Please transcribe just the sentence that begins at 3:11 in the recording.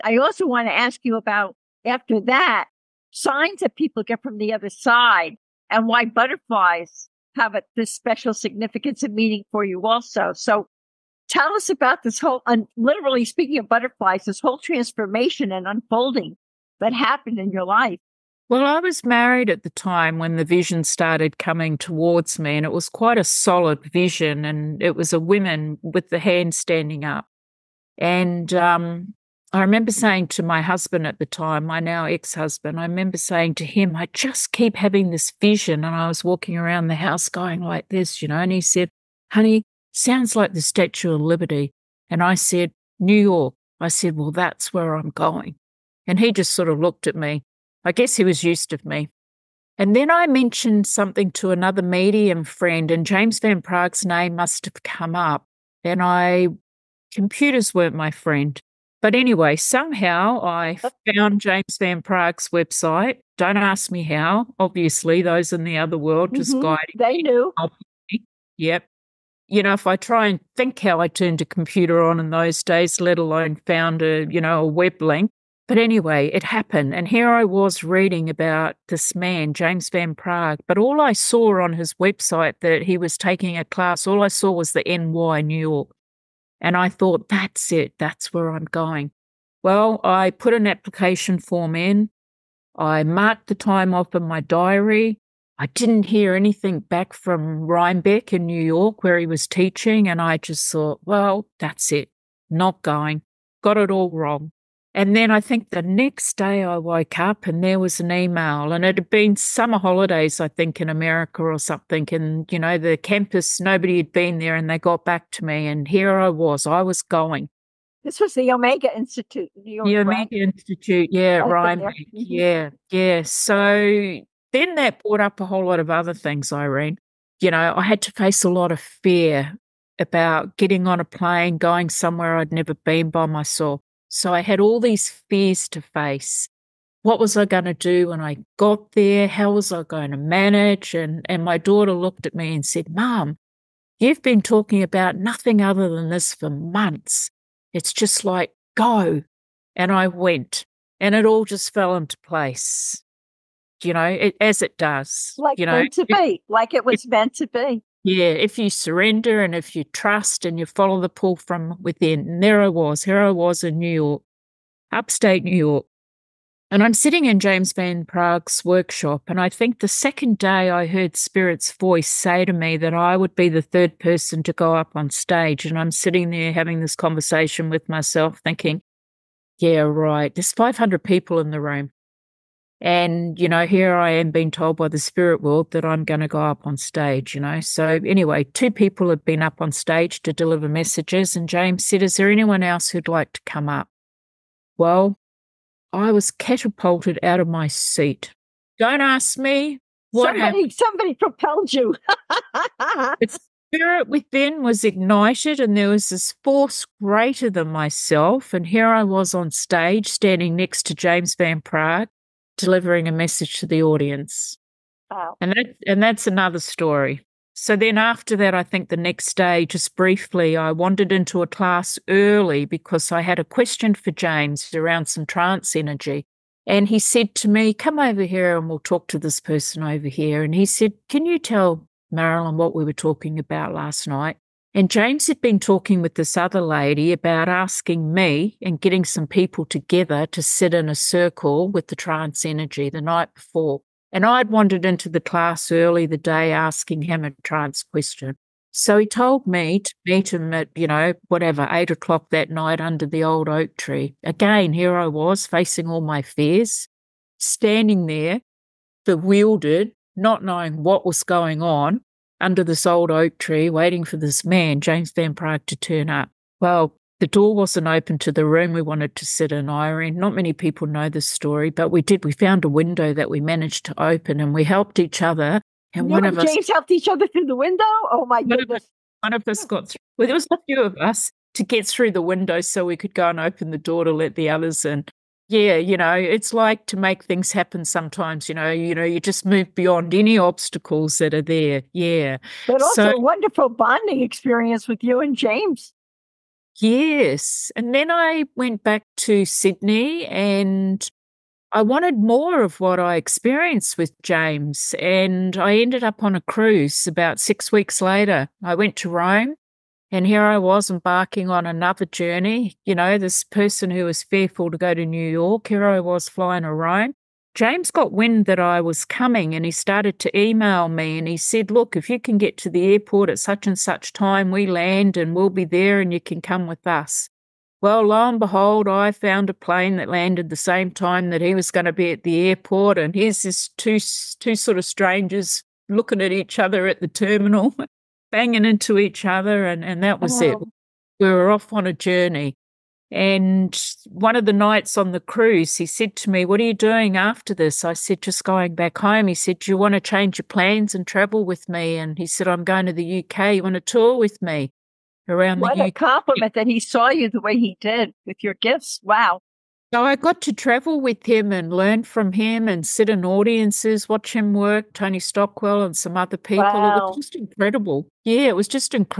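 And James said, Is there anyone else who'd like to come up?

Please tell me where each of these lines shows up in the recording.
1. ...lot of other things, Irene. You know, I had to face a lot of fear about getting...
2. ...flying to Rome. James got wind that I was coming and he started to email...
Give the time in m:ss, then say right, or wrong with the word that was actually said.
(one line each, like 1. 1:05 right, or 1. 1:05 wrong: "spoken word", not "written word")
1. 2:05 right
2. 5:16 right.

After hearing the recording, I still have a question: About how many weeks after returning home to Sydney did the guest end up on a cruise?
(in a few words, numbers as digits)
6 weeks.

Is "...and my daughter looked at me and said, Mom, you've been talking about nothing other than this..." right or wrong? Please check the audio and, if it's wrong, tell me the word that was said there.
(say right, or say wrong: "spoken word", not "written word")
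right.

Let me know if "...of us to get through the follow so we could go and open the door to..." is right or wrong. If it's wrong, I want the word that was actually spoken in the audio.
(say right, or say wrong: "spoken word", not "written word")
wrong: "window", not "follow".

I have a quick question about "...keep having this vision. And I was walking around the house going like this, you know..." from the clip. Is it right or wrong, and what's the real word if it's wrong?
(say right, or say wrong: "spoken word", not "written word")
right.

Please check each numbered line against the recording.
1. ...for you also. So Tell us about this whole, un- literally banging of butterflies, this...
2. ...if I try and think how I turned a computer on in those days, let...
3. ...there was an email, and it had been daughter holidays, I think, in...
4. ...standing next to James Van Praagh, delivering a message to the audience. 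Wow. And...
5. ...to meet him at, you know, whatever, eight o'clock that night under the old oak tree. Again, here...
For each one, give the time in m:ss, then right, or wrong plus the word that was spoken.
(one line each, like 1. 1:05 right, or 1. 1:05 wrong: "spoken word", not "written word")
1. 0:09 wrong: "speaking", not "banging"
2. 1:09 right
3. 1:47 wrong: "summer", not "daughter"
4. 3:30 right
5. 4:09 right.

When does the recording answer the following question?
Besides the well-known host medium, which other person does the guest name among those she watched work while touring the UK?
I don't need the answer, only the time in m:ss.
6:04.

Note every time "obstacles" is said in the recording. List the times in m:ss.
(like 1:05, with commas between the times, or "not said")
4:50.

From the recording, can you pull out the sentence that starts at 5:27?
Well, lo and behold, I found a plane that landed the same time that he was going to be at the airport.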